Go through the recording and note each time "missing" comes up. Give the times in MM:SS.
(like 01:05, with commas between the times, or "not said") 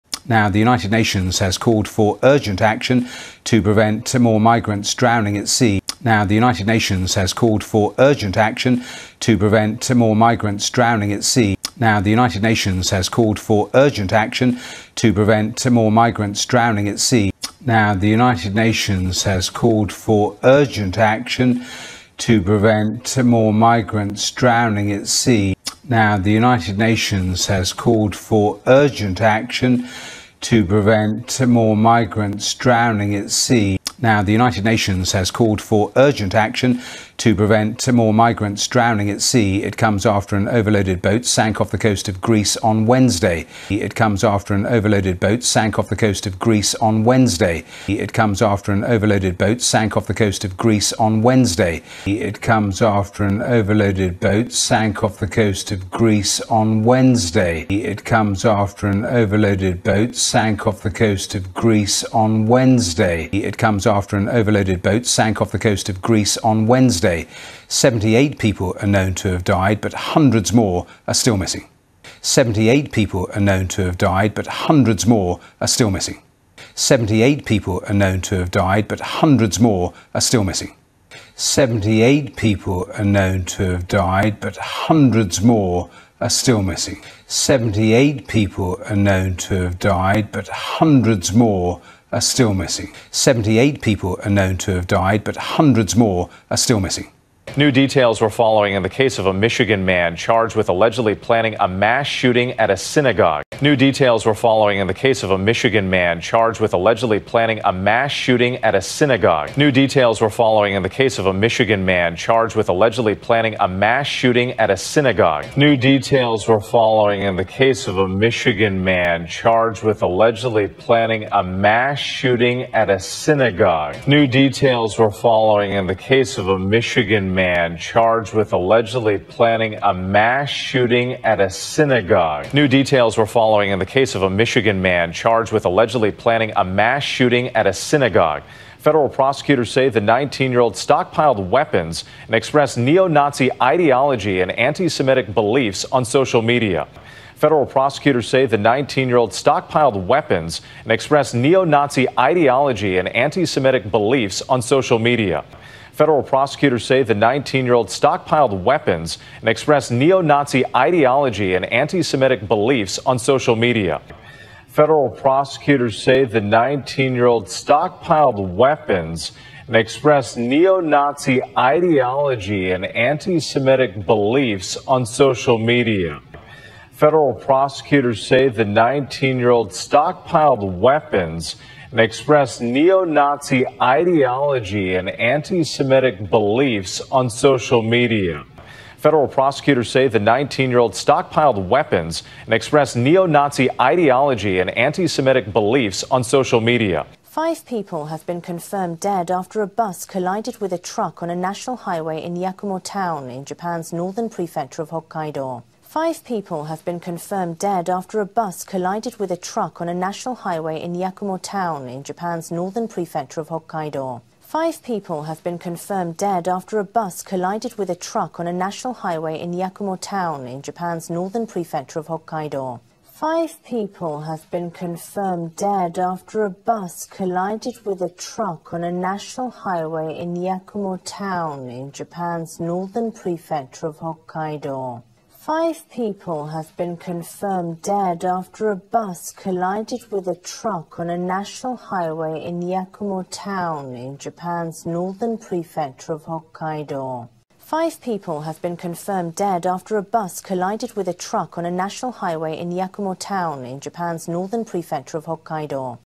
01:11, 01:15, 01:20, 01:26, 01:32, 01:36.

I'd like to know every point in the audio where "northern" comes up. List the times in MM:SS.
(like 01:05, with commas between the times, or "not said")
03:23, 03:32, 03:41, 03:52, 04:04, 04:14.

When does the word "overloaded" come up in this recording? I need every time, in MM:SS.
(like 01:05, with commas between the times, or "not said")
00:40, 00:44, 00:48, 00:53, 00:59, 01:04.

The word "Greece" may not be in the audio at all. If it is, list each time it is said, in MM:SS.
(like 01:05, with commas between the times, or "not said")
00:42, 00:46, 00:50, 00:55, 01:01, 01:06.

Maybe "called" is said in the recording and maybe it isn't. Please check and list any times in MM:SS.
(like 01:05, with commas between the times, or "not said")
00:01, 00:07, 00:13, 00:19, 00:27, 00:35.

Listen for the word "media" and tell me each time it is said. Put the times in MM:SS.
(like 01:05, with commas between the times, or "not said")
02:26, 02:34, 02:43, 02:55, 03:07, 03:16.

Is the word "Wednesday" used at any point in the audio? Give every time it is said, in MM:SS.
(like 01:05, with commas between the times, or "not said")
00:42, 00:47, 00:51, 00:56, 01:02, 01:06.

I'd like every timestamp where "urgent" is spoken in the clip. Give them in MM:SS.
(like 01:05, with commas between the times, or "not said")
00:02, 00:07, 00:13, 00:20, 00:28, 00:35.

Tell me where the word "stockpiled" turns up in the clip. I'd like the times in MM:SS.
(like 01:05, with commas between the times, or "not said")
02:20, 02:29, 02:37, 02:47, 02:59, 03:10.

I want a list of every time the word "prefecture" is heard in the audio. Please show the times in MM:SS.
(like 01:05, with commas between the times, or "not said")
03:24, 03:32, 03:41, 03:53, 04:05, 04:14.